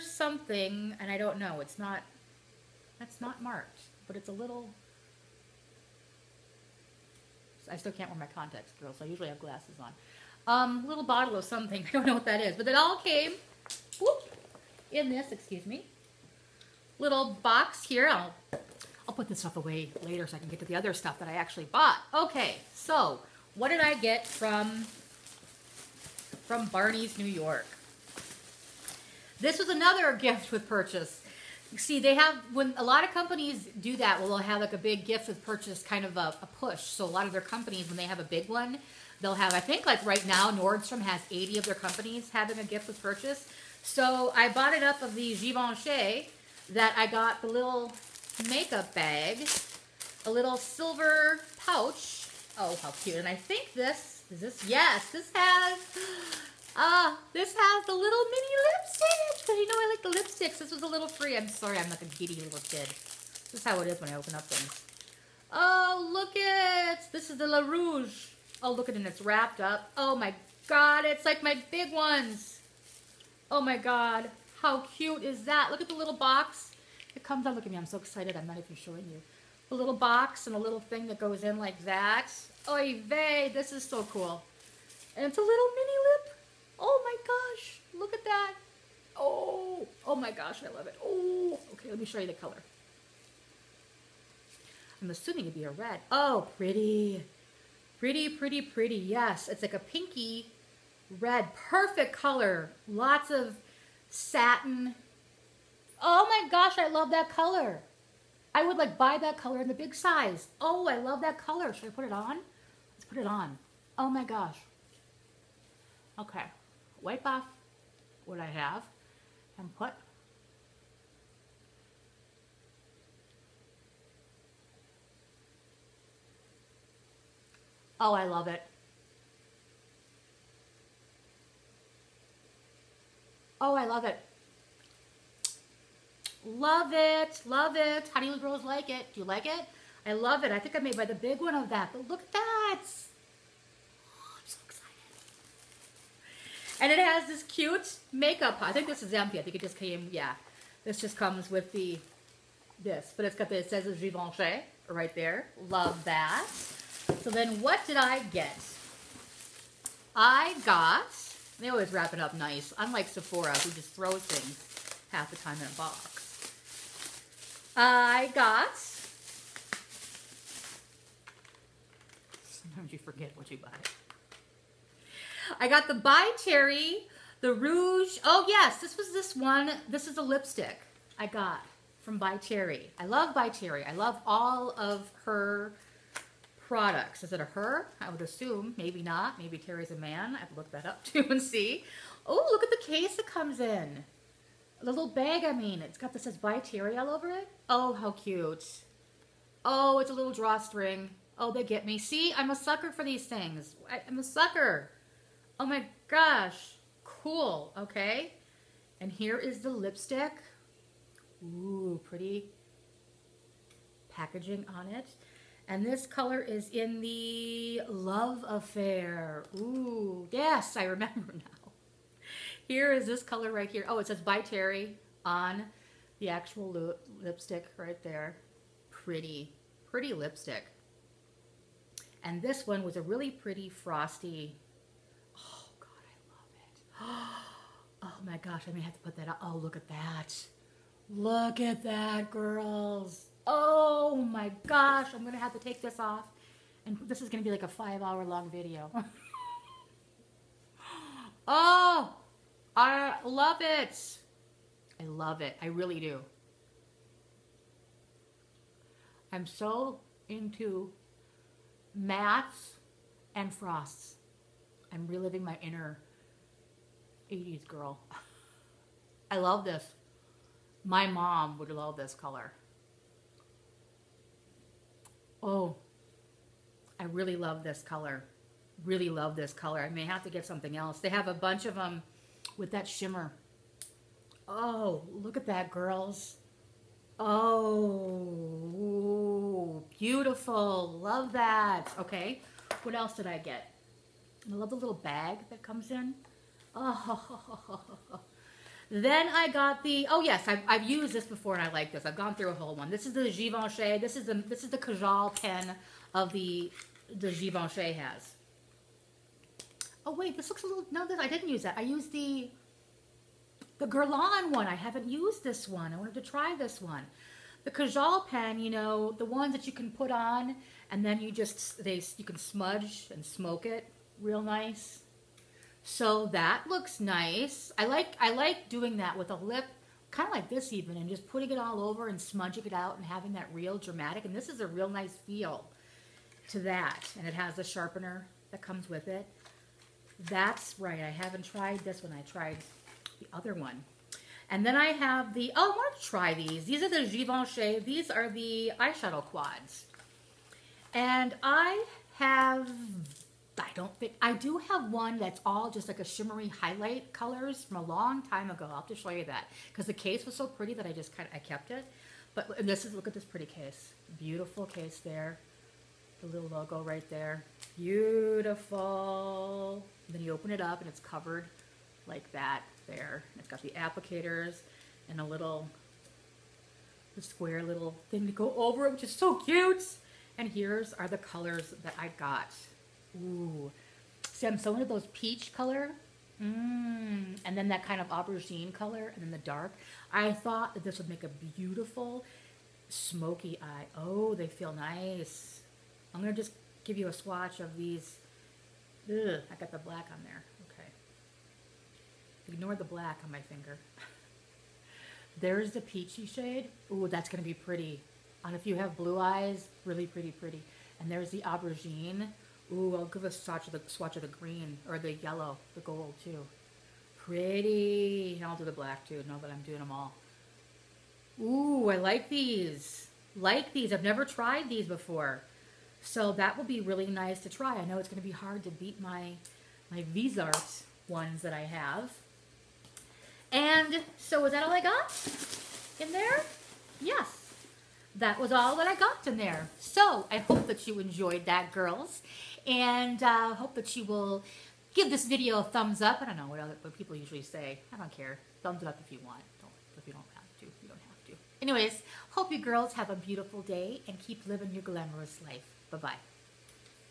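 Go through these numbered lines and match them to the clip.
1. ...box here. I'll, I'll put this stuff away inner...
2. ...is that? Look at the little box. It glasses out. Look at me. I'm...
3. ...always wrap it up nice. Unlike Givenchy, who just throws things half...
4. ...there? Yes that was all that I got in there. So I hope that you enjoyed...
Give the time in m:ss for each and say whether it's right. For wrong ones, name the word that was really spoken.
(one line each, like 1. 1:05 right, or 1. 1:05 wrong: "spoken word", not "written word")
1. 0:17 wrong: "later", not "inner"
2. 1:15 wrong: "comes", not "glasses"
3. 2:41 wrong: "Sephora", not "Givenchy"
4. 7:16 right.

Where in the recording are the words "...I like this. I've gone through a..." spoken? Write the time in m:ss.
5:01.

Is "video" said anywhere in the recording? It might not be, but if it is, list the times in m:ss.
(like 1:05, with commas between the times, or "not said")
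4:08, 7:25.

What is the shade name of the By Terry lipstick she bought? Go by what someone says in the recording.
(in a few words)
Love Affair.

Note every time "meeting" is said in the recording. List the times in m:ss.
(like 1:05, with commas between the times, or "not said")
not said.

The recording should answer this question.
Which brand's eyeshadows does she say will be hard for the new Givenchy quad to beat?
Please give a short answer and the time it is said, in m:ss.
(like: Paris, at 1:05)
Viseart, at 7:10.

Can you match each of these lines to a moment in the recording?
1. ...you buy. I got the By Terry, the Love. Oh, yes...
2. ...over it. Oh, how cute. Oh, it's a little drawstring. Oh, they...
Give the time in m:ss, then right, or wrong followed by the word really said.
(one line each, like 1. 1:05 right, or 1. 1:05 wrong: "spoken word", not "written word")
1. 2:53 wrong: "Rouge", not "Love"
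2. 3:17 right.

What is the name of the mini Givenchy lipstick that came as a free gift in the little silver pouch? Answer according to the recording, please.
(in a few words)
La Rouge.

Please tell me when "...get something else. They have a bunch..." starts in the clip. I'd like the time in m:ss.
4:40.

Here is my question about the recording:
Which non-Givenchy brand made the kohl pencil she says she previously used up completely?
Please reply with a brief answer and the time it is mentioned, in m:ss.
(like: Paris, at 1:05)
Guerlain, at 5:13.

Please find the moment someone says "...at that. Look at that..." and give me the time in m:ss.
3:59.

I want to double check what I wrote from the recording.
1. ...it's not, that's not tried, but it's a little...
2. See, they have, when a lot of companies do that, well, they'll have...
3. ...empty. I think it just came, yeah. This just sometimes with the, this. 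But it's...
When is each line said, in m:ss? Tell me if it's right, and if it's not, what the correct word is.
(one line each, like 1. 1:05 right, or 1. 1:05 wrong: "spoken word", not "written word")
1. 0:01 wrong: "marked", not "tried"
2. 0:31 right
3. 2:29 wrong: "comes", not "sometimes".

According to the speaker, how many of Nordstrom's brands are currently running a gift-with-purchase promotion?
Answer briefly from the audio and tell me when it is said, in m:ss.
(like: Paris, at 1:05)
80, at 0:41.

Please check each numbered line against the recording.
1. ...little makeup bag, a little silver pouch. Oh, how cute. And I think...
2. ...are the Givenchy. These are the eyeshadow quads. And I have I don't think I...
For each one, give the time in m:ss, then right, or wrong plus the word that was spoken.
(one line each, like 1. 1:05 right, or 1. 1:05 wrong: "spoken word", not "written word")
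1. 0:47 right
2. 5:46 right.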